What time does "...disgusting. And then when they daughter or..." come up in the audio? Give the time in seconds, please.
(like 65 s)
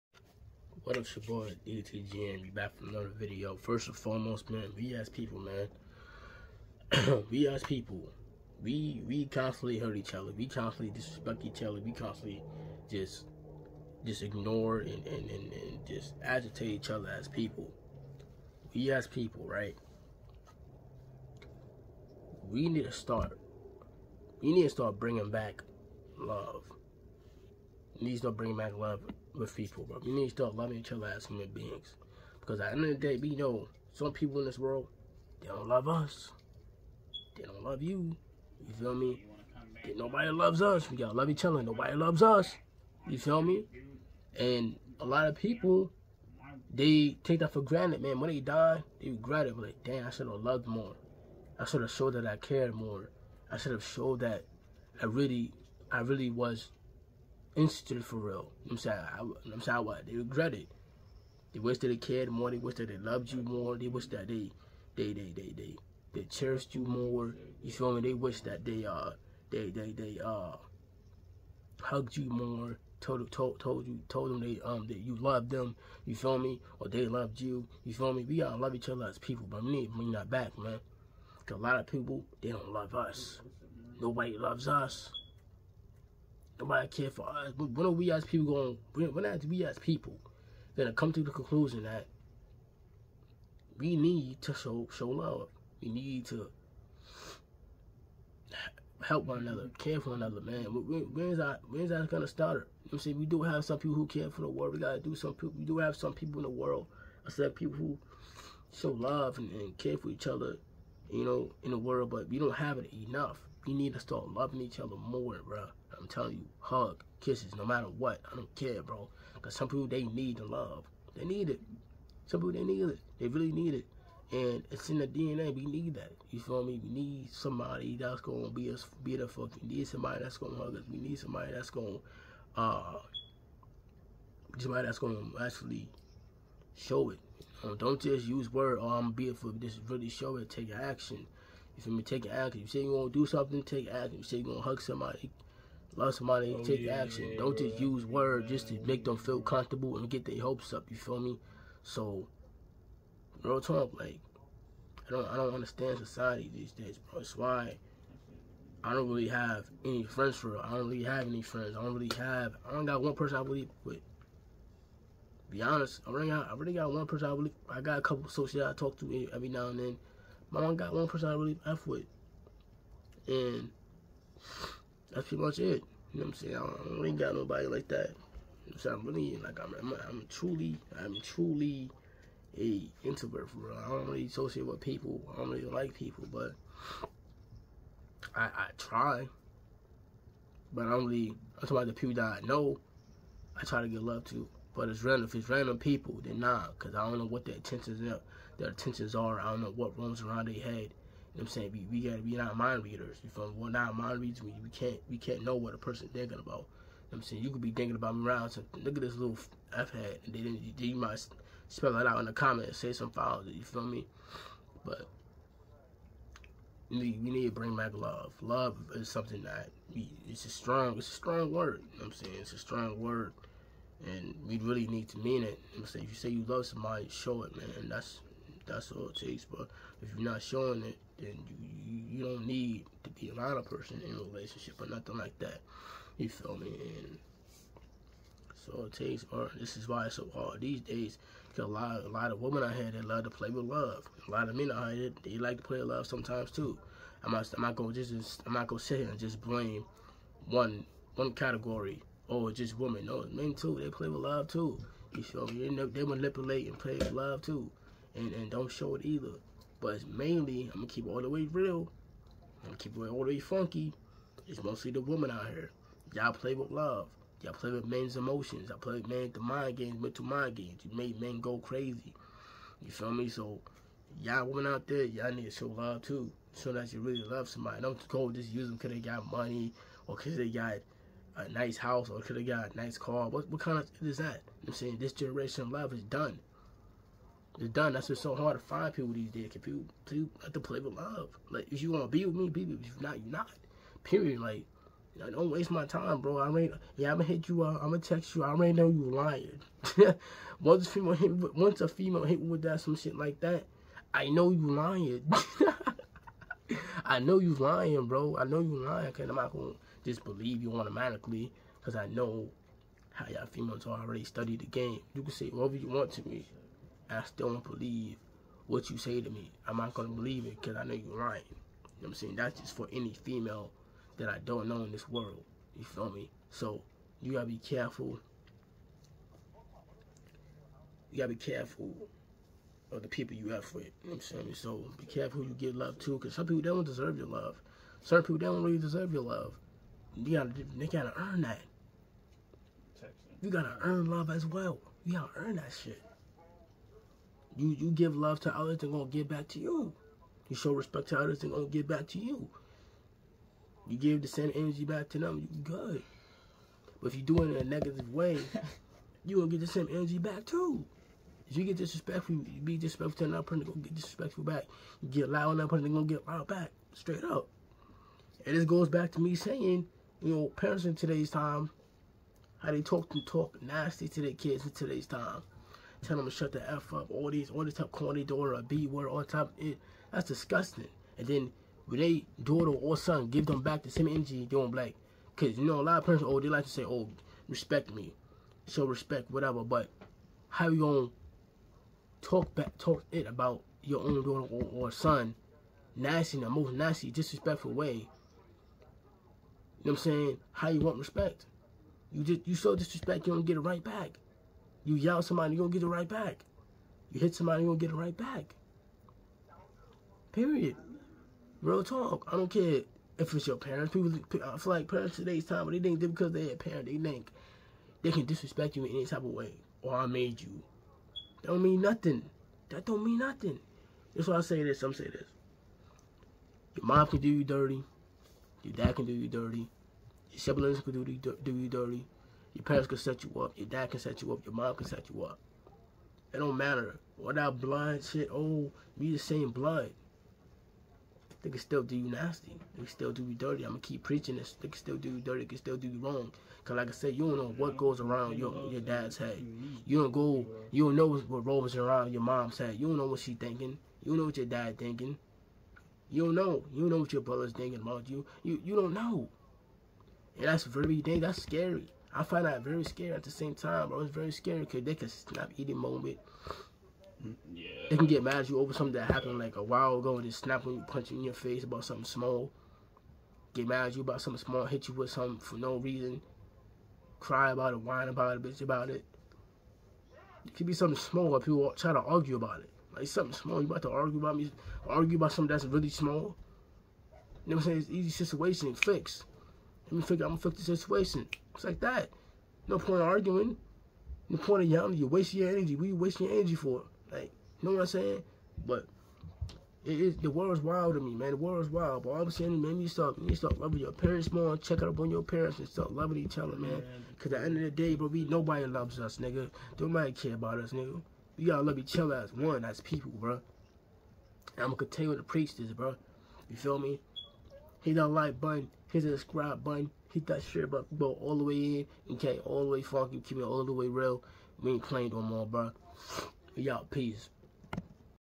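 380 s.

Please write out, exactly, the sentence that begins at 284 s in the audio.
I'm saying this generation of love is done.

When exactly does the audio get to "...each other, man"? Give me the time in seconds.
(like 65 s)
506 s.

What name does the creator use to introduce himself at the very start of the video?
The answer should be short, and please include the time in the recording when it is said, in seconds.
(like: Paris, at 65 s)
DTG, at 1 s.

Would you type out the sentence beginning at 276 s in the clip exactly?
Show that you really love somebody.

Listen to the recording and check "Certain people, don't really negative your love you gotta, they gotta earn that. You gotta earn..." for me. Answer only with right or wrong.
wrong.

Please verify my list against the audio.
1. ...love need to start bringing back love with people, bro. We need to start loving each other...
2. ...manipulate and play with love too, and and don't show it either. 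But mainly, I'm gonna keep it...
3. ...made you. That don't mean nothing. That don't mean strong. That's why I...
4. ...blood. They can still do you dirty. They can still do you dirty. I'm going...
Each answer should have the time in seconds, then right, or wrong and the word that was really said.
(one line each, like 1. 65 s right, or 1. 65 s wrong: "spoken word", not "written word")
1. 26 s right
2. 256 s right
3. 420 s wrong: "nothing", not "strong"
4. 439 s wrong: "nasty", not "dirty".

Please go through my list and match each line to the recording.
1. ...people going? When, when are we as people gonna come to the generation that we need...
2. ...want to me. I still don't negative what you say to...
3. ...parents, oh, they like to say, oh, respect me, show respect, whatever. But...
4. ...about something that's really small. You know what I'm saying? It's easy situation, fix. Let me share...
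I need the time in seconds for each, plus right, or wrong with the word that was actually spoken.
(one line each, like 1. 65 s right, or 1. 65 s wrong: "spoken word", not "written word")
1. 88 s wrong: "conclusion", not "generation"
2. 315 s wrong: "believe", not "negative"
3. 386 s right
4. 485 s wrong: "figure", not "share".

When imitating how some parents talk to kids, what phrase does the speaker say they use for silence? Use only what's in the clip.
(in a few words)
shut the F up.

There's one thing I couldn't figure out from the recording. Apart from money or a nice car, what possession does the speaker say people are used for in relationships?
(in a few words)
a nice house.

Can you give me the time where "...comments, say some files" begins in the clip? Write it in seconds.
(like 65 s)
212 s.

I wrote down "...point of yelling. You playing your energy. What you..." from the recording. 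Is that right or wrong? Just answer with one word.
wrong.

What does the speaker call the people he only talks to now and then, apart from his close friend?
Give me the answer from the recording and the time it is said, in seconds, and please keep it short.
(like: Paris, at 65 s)
associates, at 168 s.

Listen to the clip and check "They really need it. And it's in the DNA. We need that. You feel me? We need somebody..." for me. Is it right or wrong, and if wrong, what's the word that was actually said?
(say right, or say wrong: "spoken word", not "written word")
right.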